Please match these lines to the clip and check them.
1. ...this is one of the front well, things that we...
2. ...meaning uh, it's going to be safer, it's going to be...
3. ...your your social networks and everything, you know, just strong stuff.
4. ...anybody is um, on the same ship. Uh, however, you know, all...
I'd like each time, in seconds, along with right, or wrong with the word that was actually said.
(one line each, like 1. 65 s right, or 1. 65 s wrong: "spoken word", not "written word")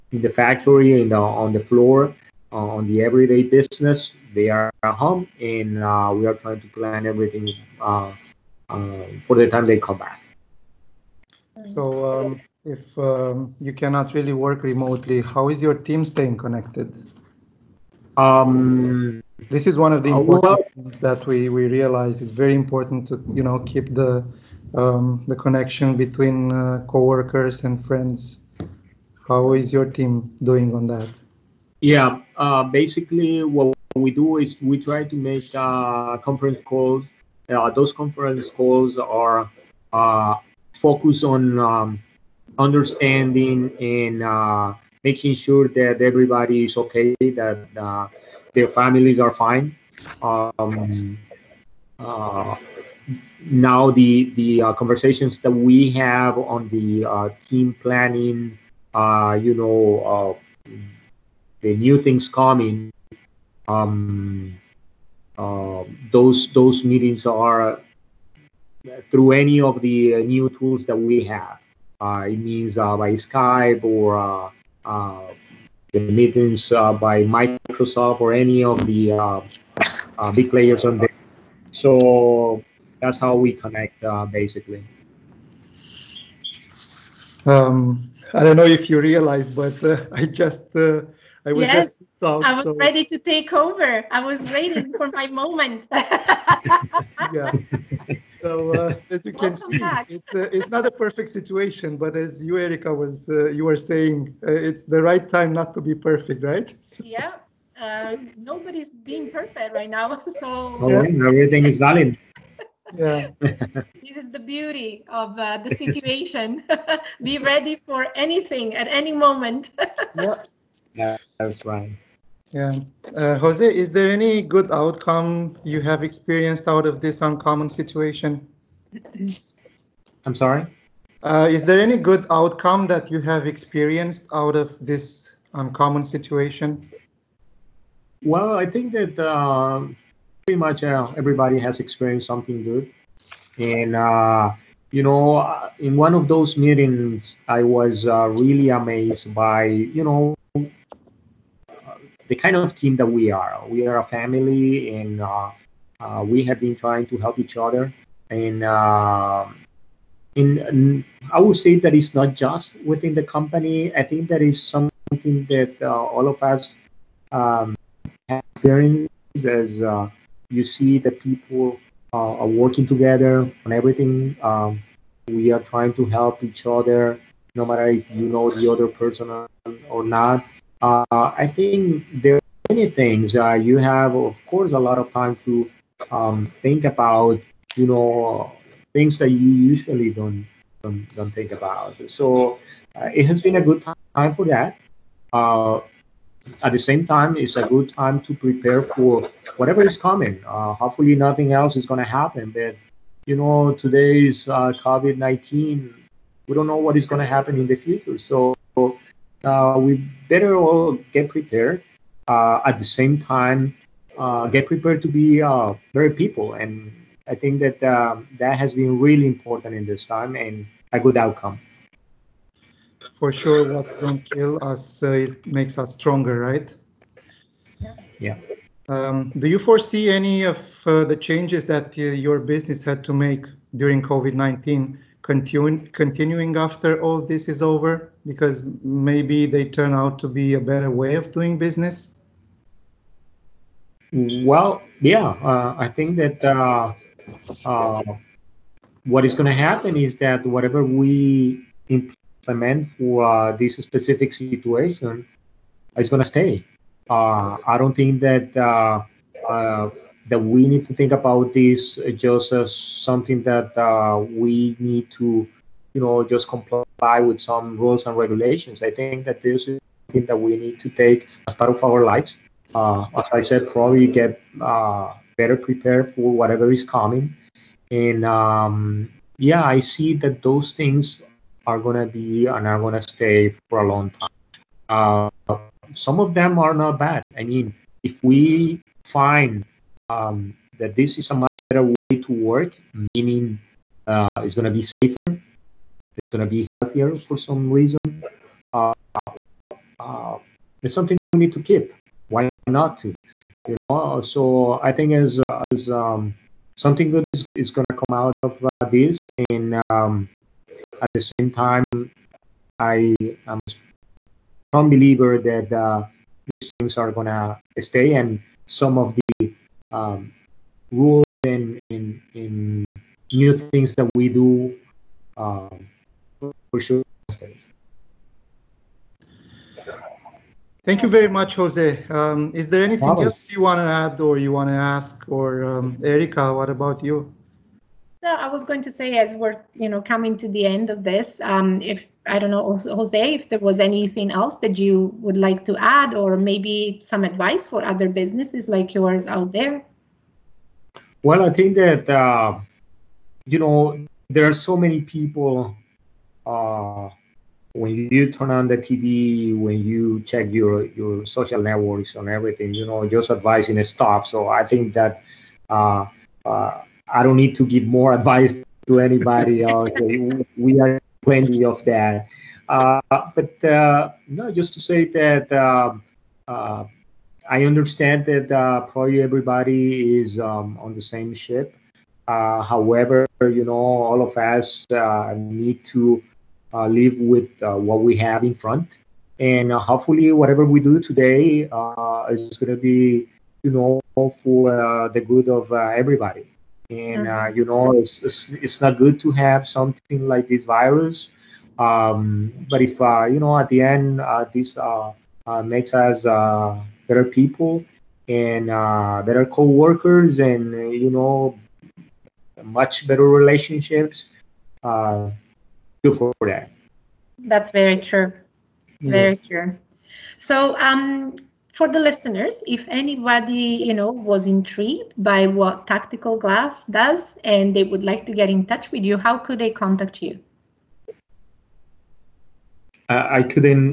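1. 19 s wrong: "important", not "front"
2. 292 s right
3. 360 s wrong: "advising", not "strong"
4. 379 s wrong: "everybody", not "anybody".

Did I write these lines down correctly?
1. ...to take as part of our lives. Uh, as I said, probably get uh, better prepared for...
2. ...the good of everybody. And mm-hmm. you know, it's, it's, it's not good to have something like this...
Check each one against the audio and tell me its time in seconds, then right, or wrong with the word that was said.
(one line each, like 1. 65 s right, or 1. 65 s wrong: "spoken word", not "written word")
1. 270 s right
2. 395 s right.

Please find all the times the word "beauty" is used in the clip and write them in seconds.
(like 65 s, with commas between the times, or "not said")
114 s.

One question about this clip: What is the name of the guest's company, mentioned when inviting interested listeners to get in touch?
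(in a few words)
Tactical Glass.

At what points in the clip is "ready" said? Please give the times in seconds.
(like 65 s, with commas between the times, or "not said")
92 s, 117 s.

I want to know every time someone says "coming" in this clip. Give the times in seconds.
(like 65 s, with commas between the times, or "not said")
62 s, 199 s, 276 s, 340 s.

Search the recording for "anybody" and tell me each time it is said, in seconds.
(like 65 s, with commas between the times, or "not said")
368 s, 422 s.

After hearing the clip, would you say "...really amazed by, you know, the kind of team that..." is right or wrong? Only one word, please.
right.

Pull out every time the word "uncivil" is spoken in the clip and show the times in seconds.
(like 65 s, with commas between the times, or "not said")
not said.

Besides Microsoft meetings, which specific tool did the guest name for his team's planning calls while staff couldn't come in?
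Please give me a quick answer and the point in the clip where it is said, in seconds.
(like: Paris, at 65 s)
Skype, at 73 s.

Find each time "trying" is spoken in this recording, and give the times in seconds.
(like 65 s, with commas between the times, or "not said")
6 s, 156 s, 175 s.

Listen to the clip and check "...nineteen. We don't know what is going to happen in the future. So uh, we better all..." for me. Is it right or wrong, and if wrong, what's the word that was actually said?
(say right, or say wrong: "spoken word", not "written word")
right.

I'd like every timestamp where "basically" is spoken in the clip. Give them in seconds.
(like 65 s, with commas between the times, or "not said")
32 s, 84 s.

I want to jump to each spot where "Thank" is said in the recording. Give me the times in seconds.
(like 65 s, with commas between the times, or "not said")
330 s.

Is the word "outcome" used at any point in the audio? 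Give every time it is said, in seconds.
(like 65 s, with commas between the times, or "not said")
124 s, 132 s, 221 s.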